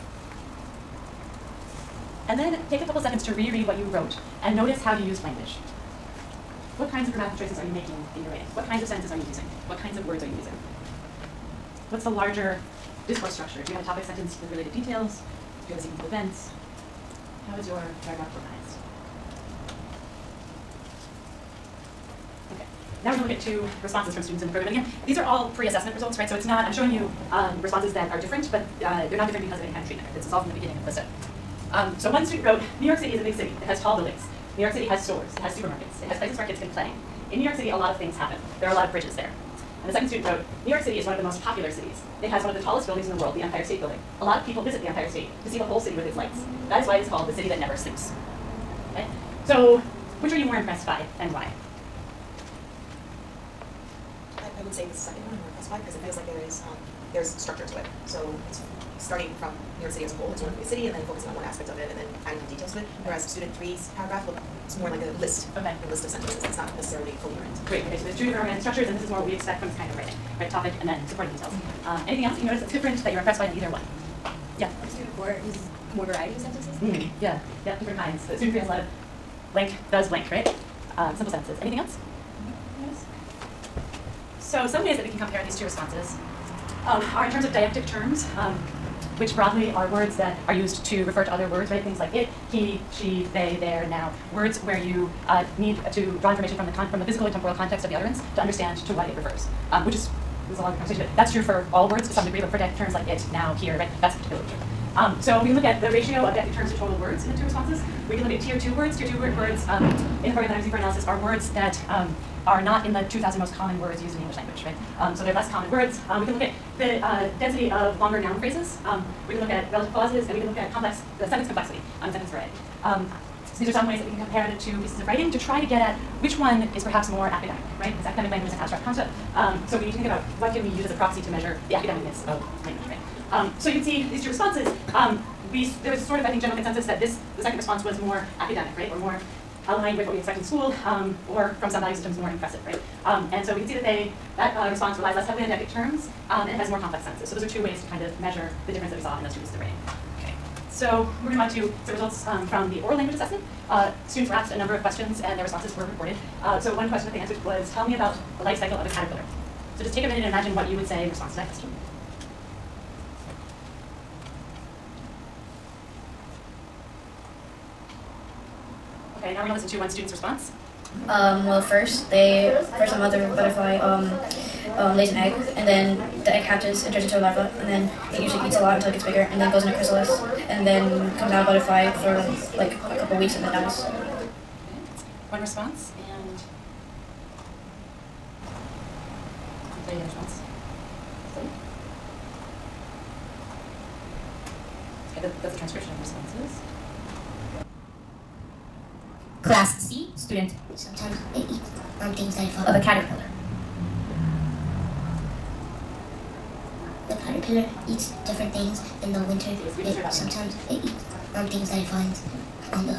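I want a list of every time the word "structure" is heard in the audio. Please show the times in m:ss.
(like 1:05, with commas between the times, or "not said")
0:13, 0:57, 1:08.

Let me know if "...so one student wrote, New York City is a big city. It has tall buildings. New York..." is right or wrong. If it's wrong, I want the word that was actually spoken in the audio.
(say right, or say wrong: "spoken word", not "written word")
right.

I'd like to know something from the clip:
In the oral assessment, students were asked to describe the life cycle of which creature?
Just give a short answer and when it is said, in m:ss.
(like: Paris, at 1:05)
a caterpillar, at 2:38.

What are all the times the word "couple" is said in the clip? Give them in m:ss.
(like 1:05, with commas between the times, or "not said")
0:02, 3:02.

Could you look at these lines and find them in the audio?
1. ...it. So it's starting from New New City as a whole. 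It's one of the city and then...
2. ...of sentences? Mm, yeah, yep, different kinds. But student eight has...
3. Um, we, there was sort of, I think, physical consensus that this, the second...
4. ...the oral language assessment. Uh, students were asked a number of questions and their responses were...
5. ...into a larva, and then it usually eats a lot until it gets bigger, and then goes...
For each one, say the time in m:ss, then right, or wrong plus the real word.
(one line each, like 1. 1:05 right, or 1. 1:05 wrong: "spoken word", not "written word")
1. 0:57 wrong: "York", not "New"
2. 1:16 wrong: "three", not "eight"
3. 2:14 wrong: "general", not "physical"
4. 2:32 right
5. 2:57 right.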